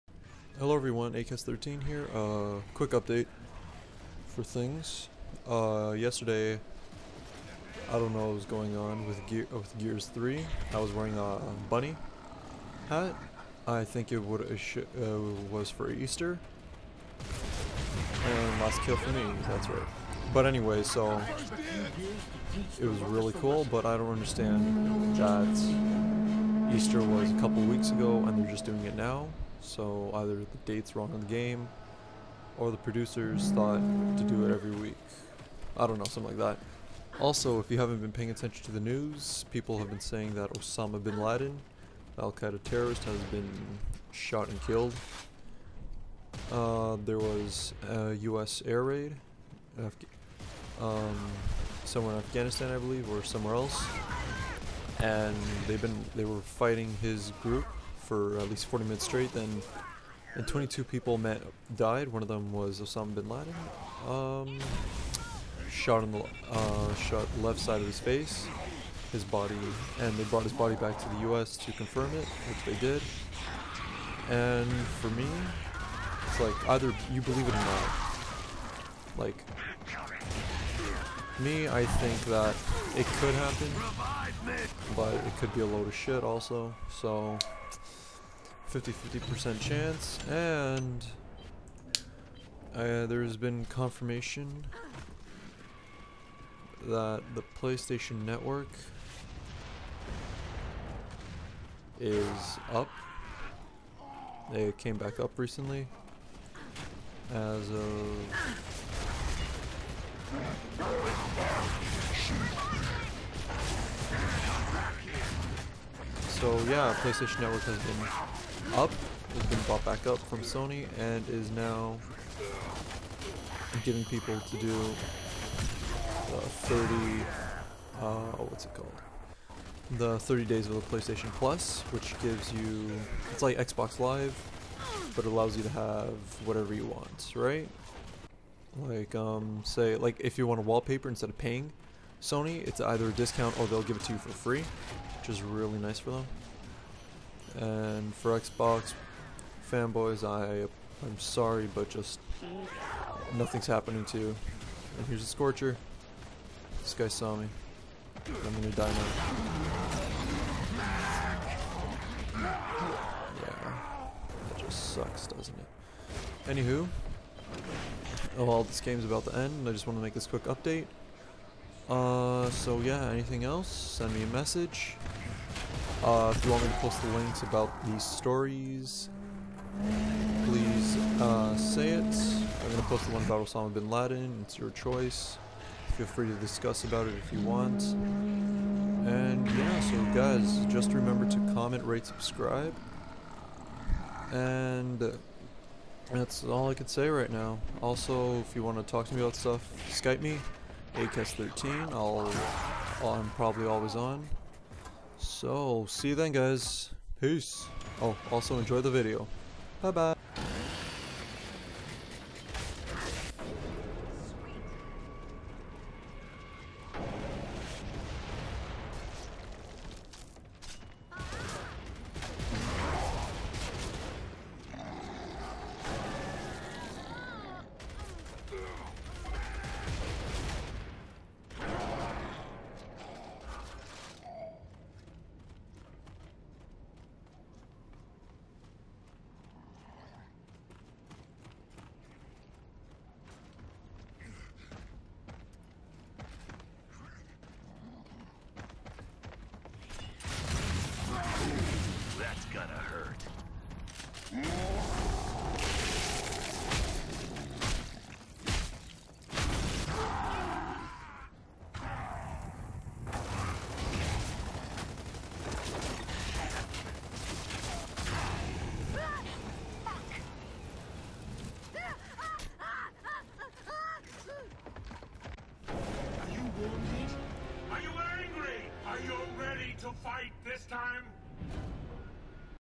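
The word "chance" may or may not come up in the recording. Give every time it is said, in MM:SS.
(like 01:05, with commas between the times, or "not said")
01:29.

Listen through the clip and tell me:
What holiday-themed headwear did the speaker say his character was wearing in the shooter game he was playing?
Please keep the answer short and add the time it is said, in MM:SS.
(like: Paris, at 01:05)
Bunny hat, at 00:11.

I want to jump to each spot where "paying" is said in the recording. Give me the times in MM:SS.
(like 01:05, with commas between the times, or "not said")
00:38, 02:21.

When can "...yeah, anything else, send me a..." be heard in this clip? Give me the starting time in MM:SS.
02:52.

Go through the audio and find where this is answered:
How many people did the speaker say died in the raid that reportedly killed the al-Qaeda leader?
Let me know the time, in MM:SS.
01:00.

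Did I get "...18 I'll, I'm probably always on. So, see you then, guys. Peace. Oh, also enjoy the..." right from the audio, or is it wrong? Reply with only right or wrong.
wrong.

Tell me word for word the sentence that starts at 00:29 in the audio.
So either the date's wrong on the game, or the producers thought to do it every week.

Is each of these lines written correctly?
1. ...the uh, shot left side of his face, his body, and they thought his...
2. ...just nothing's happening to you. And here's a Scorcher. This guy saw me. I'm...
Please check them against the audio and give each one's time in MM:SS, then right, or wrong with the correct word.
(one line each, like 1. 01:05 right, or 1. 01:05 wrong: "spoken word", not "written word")
1. 01:06 wrong: "brought", not "thought"
2. 02:31 right.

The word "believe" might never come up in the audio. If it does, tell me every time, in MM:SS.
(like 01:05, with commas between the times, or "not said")
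00:52, 01:17.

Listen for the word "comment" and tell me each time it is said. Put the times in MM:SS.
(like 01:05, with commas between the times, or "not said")
03:11.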